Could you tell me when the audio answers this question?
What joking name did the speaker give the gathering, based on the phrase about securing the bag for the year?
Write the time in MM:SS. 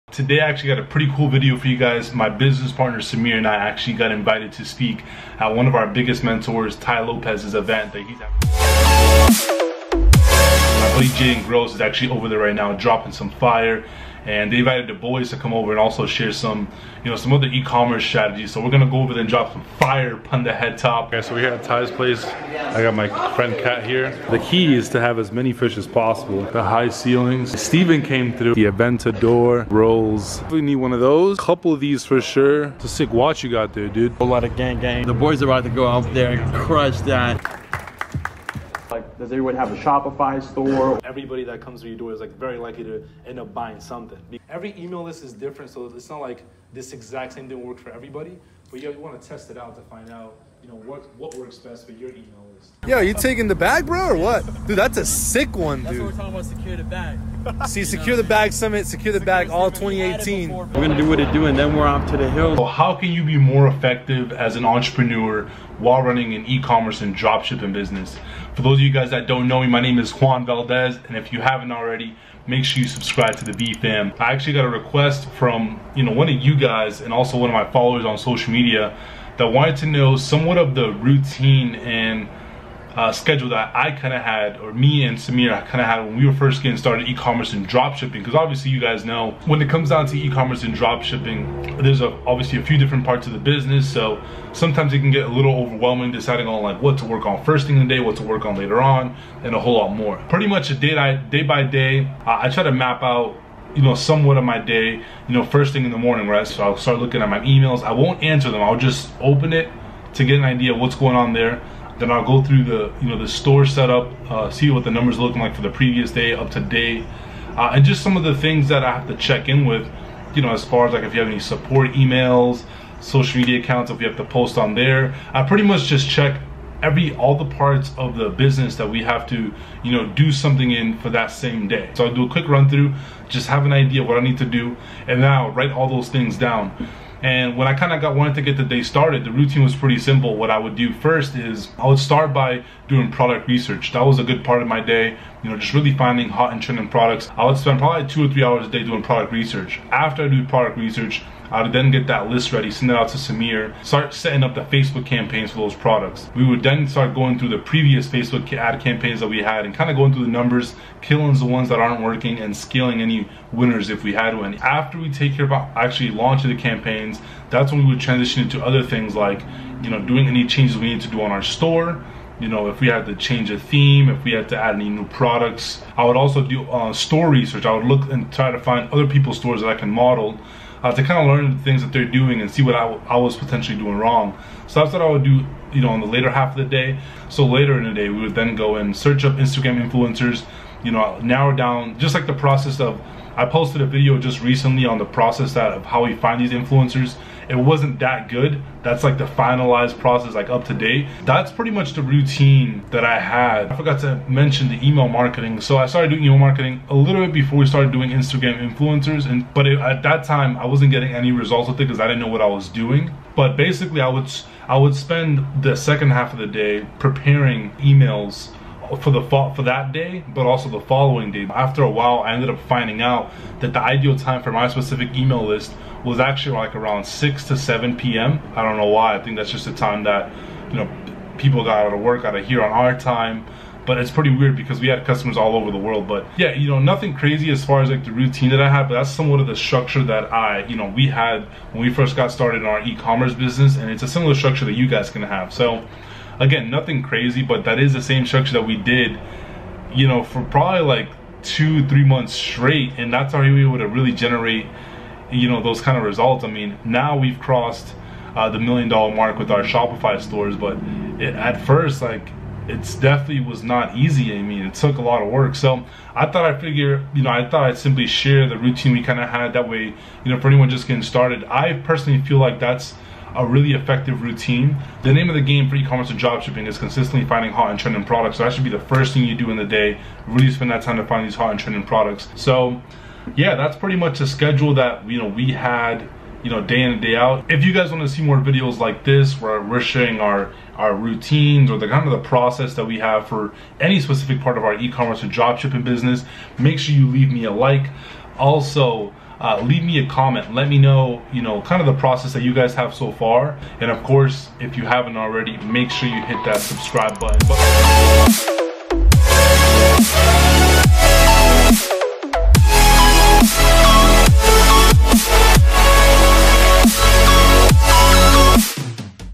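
00:57.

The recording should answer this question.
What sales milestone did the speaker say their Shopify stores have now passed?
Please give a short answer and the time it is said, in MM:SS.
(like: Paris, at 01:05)
million dollar mark, at 04:18.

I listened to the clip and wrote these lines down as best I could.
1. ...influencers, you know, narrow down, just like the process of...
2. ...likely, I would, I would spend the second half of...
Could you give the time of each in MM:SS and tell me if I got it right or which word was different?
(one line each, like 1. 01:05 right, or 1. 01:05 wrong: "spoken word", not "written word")
1. 03:09 right
2. 03:33 wrong: "basically", not "likely".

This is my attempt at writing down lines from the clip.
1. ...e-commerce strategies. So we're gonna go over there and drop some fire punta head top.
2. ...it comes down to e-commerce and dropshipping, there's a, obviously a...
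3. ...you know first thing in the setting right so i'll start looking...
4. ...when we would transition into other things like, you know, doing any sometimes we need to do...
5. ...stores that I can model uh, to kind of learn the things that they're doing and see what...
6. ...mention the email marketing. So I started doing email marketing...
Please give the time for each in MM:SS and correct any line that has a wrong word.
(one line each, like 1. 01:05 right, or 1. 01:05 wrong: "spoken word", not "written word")
1. 00:17 right
2. 01:29 right
3. 01:45 wrong: "morning", not "setting"
4. 02:47 wrong: "changes", not "sometimes"
5. 02:59 right
6. 03:24 right.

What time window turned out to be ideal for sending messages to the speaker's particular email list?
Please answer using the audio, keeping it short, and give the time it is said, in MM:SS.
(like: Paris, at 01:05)
6 to 7 p.m., at 03:47.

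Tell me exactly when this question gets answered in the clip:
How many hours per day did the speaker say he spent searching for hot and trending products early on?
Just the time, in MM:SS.
02:28.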